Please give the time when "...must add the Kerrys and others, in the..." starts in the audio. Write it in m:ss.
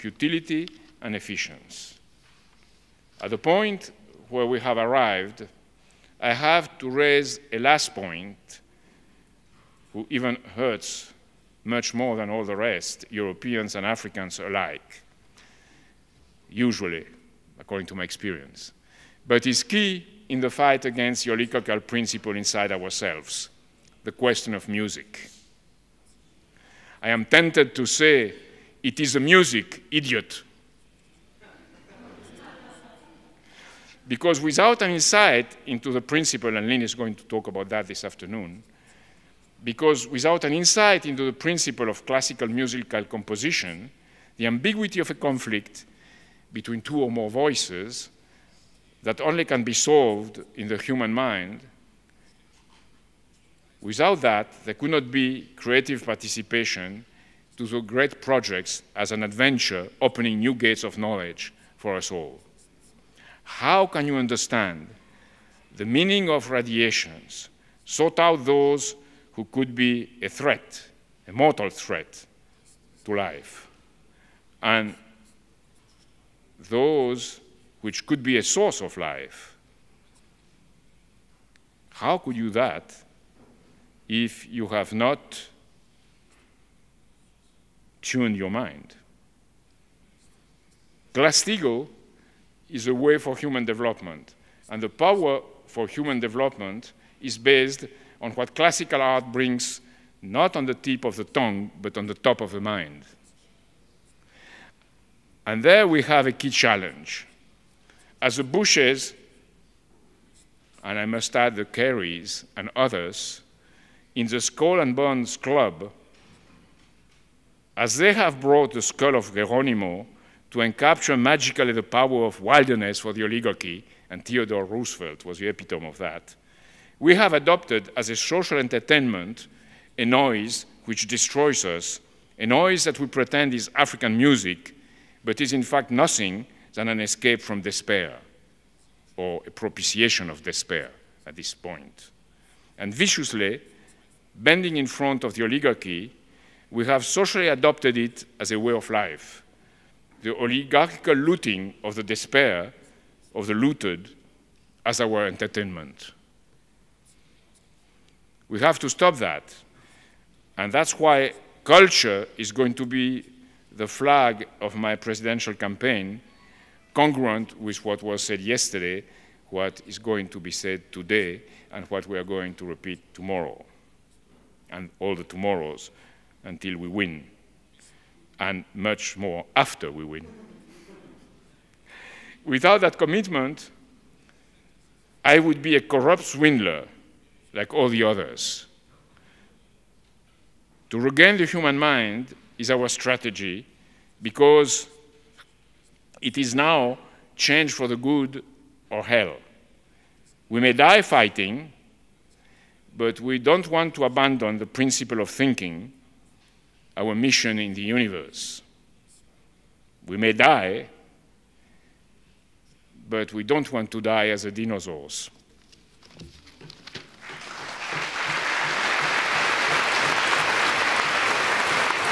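1:51.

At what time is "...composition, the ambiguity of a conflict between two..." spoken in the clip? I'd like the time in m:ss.
0:43.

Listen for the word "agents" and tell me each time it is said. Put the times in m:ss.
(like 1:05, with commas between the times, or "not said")
not said.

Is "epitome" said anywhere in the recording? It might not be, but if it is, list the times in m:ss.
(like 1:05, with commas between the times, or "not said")
2:05.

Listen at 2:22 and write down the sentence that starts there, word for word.
And viciously, bending in front of the oligarchy, we have socially adopted it as a way of life.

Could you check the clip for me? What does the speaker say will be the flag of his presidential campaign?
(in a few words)
culture.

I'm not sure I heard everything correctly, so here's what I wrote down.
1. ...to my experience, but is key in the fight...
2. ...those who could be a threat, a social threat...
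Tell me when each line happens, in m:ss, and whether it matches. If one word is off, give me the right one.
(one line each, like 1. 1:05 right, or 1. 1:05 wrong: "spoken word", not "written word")
1. 0:17 right
2. 1:08 wrong: "mortal", not "social".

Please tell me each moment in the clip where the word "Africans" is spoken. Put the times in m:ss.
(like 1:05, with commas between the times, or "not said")
0:13, 2:13.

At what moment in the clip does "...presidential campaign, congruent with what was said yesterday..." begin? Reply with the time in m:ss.
2:44.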